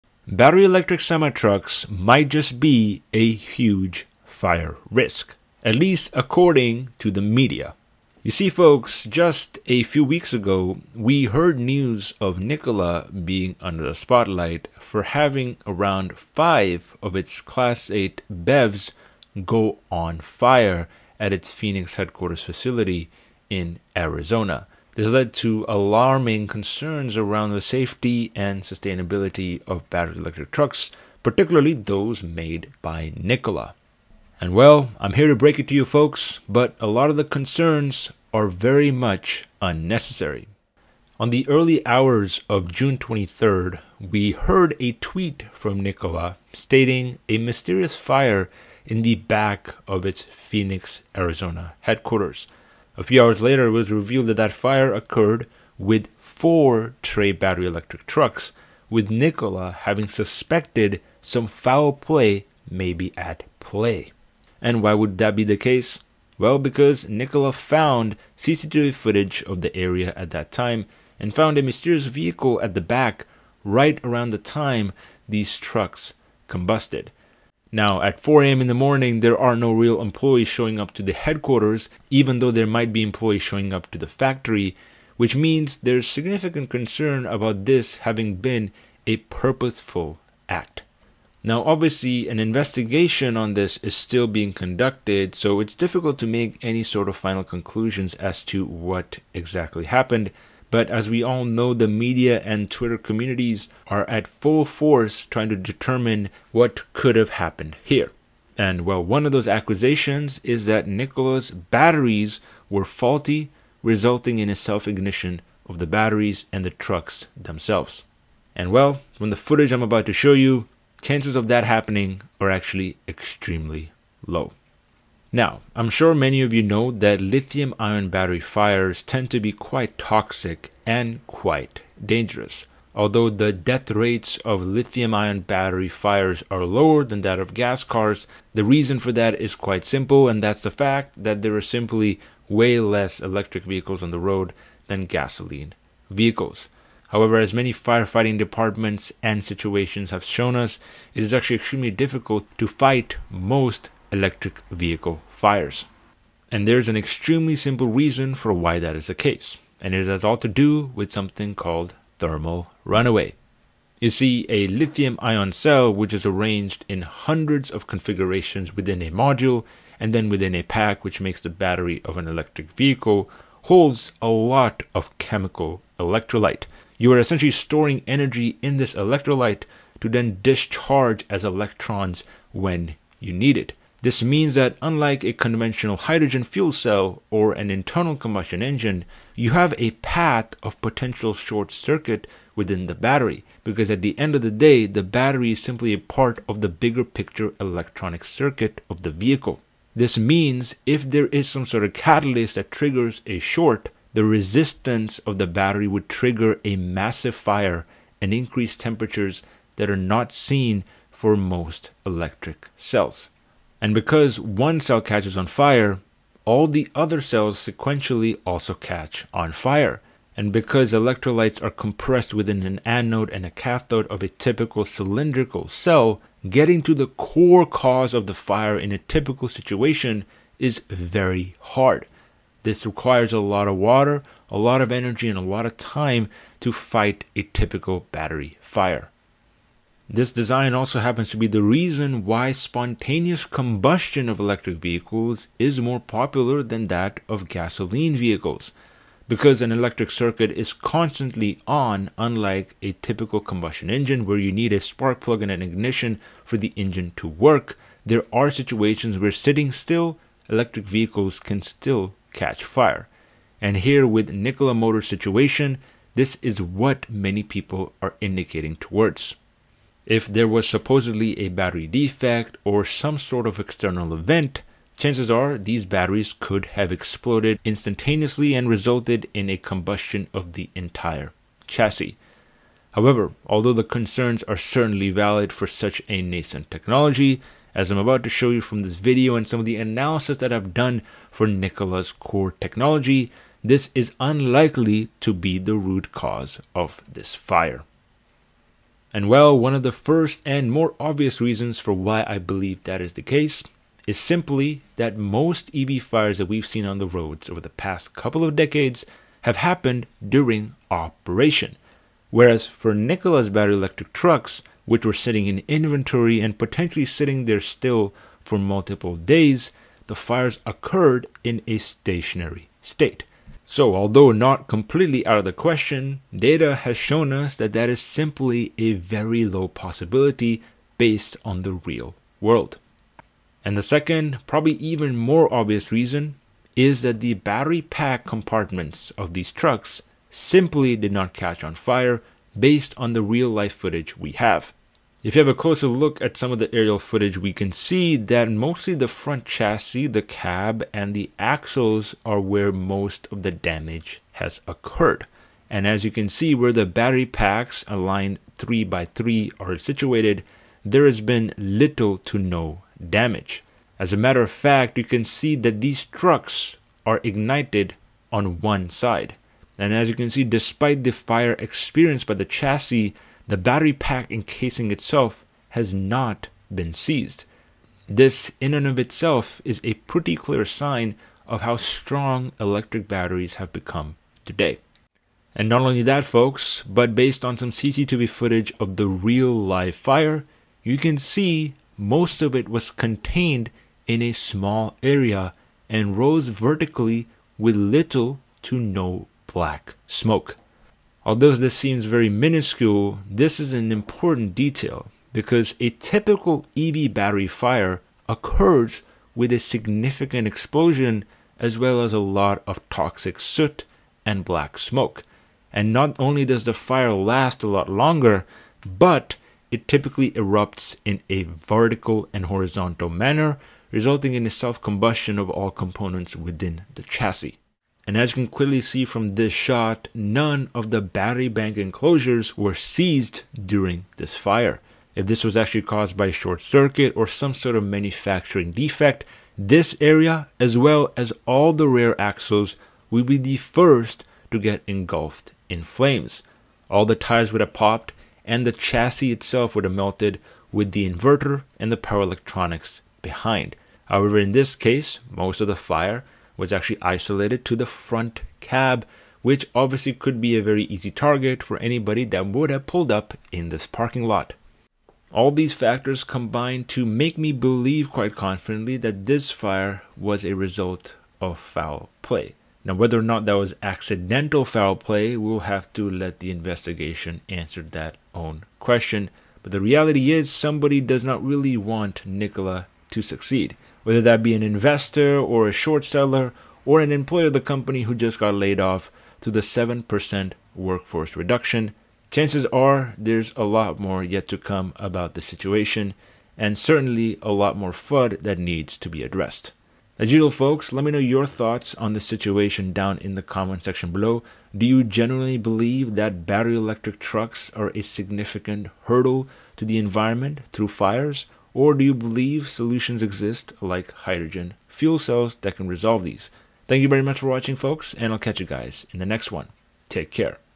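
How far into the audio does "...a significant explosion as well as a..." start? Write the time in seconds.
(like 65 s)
409 s.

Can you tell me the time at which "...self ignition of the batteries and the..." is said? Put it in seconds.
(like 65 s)
114 s.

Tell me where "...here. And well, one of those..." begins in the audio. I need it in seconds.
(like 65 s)
107 s.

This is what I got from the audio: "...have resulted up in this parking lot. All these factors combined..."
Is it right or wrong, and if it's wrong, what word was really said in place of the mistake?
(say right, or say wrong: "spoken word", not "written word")
wrong: "pulled", not "resulted".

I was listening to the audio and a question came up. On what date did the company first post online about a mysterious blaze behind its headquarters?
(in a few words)
June 23rd.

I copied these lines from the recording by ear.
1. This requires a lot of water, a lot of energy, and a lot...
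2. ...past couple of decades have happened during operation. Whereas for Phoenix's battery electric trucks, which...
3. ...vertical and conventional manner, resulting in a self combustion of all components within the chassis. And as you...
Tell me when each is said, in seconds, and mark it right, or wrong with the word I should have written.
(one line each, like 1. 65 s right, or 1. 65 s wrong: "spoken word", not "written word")
1. 232 s right
2. 307 s wrong: "Nikola", not "Phoenix"
3. 421 s wrong: "horizontal", not "conventional".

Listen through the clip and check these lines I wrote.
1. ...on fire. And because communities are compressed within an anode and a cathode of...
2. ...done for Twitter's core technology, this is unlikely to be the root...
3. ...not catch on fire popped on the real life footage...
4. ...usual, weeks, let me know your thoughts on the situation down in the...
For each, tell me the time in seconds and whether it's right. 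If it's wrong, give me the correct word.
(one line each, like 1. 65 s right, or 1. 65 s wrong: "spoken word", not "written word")
1. 219 s wrong: "electrolytes", not "communities"
2. 290 s wrong: "Nikola", not "Twitter"
3. 341 s wrong: "based", not "popped"
4. 500 s wrong: "folks", not "weeks".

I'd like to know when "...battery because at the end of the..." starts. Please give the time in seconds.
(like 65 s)
192 s.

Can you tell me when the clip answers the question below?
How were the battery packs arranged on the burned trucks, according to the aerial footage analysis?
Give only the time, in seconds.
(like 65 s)
358 s.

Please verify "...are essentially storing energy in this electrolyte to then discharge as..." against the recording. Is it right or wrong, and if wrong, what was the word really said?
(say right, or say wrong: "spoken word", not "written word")
right.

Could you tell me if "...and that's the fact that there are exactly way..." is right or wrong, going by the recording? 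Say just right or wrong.
wrong.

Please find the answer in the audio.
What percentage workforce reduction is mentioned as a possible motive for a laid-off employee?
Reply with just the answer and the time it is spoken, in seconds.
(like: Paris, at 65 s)
7%, at 489 s.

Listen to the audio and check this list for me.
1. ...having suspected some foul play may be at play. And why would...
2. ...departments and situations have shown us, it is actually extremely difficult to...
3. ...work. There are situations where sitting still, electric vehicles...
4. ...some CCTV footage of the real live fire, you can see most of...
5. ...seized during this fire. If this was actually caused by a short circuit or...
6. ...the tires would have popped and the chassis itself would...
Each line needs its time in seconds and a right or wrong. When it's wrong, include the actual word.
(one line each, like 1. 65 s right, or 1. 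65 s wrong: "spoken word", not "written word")
1. 59 s right
2. 148 s right
3. 257 s right
4. 387 s right
5. 432 s right
6. 447 s right.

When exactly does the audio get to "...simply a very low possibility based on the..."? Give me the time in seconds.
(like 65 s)
328 s.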